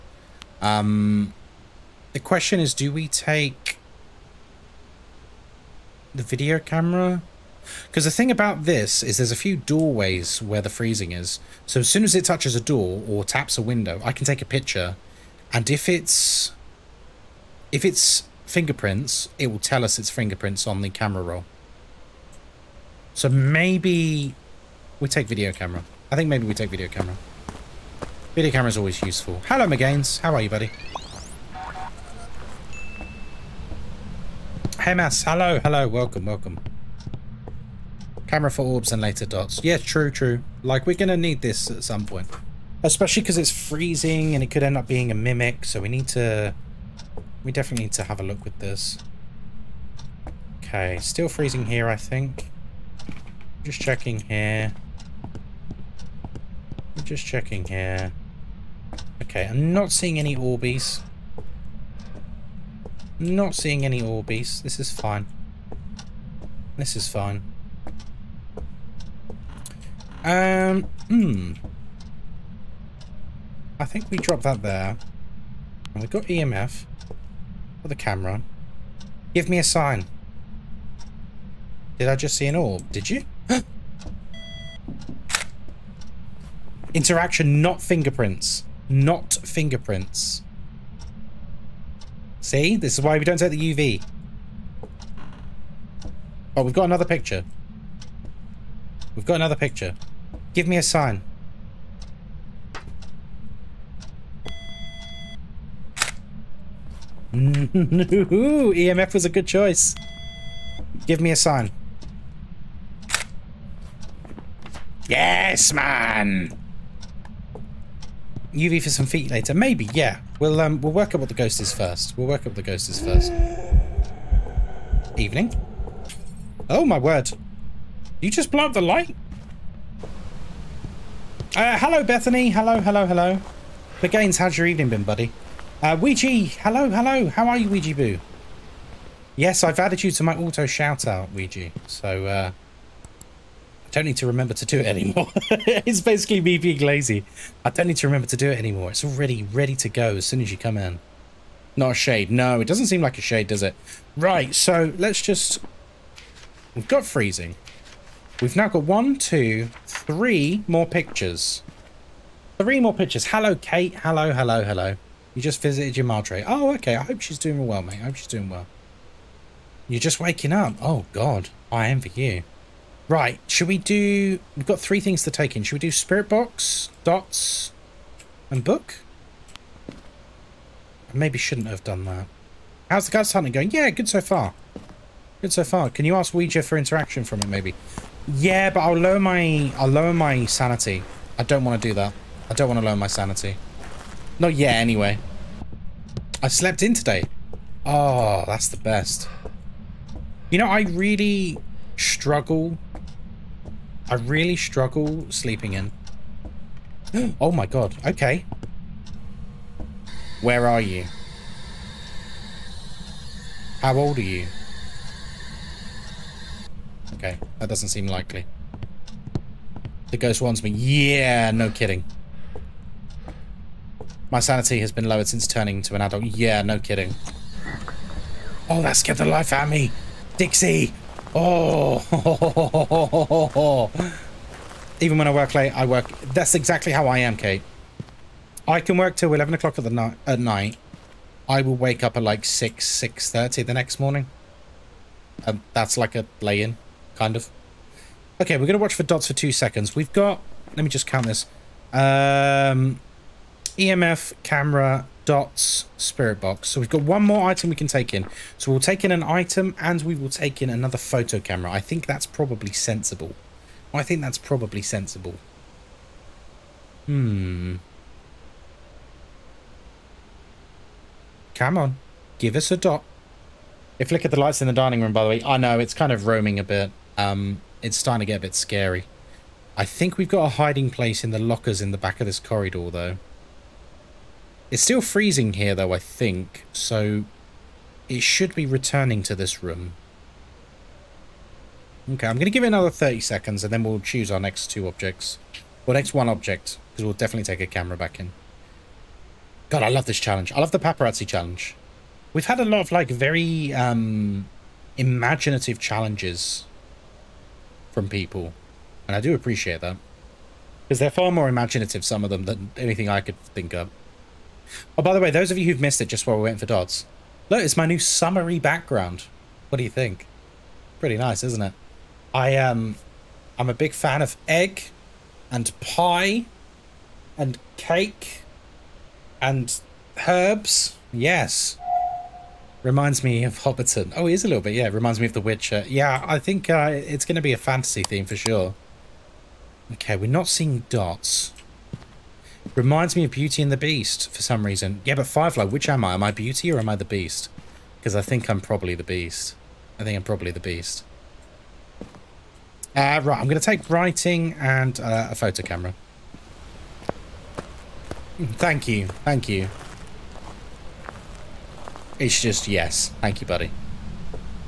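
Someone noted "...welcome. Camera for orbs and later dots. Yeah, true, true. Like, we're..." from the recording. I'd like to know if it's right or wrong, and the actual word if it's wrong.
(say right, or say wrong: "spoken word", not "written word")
right.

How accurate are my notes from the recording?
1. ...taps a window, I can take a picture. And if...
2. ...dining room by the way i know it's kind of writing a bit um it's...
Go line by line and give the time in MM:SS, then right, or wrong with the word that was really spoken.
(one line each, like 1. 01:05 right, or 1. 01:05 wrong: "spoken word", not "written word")
1. 00:13 right
2. 04:34 wrong: "roaming", not "writing".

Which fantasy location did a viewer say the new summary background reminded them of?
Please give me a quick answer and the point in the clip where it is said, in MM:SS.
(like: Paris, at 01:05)
Hobbiton, at 05:33.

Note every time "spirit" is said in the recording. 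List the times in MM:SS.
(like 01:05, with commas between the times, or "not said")
02:55, 04:15.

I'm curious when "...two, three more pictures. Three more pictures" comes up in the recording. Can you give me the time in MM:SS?
02:39.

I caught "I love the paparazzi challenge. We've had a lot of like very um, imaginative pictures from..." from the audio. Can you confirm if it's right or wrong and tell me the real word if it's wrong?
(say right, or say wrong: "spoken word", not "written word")
wrong: "challenges", not "pictures".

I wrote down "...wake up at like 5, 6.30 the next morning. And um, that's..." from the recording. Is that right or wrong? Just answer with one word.
wrong.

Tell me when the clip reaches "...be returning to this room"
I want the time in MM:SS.
04:48.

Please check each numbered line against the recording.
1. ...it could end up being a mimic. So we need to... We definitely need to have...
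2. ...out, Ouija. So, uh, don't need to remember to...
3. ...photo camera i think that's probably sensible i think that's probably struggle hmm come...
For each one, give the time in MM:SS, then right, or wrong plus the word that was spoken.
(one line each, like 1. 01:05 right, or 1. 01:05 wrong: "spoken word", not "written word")
1. 00:44 right
2. 02:21 right
3. 04:20 wrong: "sensible", not "struggle".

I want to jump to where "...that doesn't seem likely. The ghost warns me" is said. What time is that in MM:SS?
03:37.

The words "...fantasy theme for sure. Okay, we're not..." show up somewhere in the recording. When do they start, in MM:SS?
05:37.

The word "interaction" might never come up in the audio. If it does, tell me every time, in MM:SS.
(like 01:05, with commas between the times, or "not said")
01:26, 03:06.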